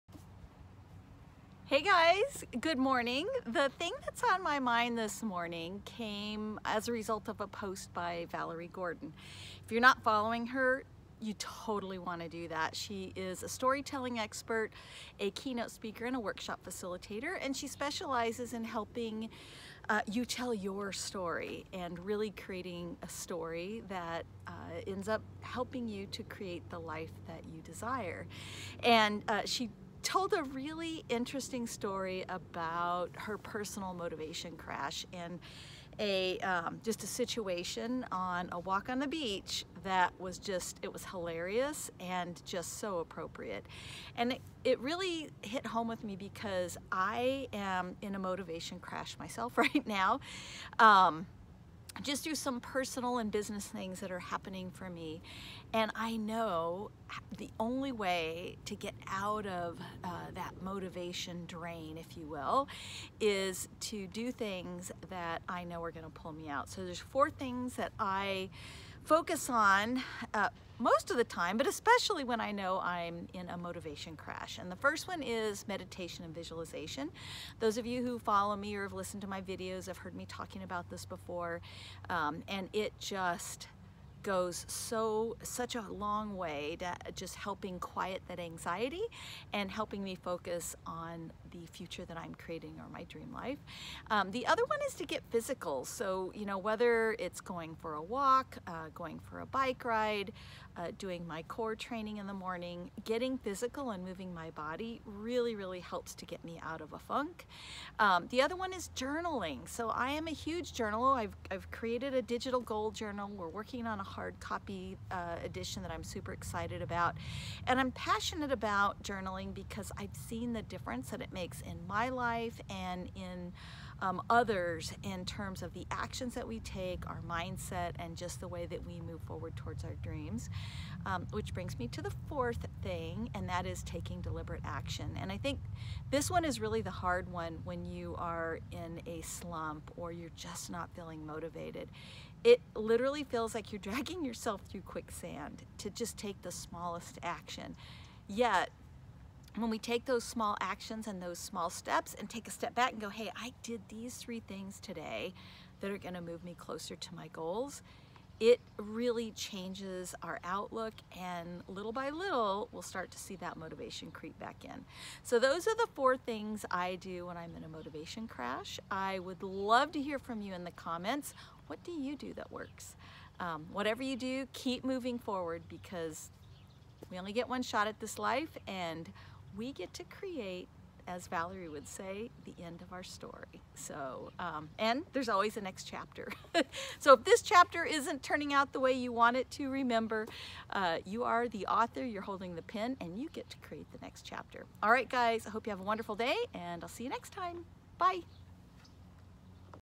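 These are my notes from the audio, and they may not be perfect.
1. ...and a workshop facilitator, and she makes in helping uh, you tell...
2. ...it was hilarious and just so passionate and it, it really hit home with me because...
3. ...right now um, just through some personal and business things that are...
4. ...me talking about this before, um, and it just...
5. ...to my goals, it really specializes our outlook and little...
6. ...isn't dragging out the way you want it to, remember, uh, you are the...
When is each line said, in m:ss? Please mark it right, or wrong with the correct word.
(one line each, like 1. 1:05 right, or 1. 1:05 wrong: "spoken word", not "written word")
1. 0:16 wrong: "specializes", not "makes"
2. 0:40 wrong: "appropriate", not "passionate"
3. 0:49 right
4. 1:20 right
5. 2:36 wrong: "changes", not "specializes"
6. 3:07 wrong: "turning", not "dragging".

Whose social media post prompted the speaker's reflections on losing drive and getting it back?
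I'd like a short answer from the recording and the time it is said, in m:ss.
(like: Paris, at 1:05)
Valerie Gordon, at 0:08.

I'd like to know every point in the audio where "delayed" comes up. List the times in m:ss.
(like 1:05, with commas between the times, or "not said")
not said.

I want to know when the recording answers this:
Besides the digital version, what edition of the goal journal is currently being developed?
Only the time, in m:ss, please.
1:54.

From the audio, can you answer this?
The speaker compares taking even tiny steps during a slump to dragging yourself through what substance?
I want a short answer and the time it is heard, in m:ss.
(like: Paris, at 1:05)
quicksand, at 2:24.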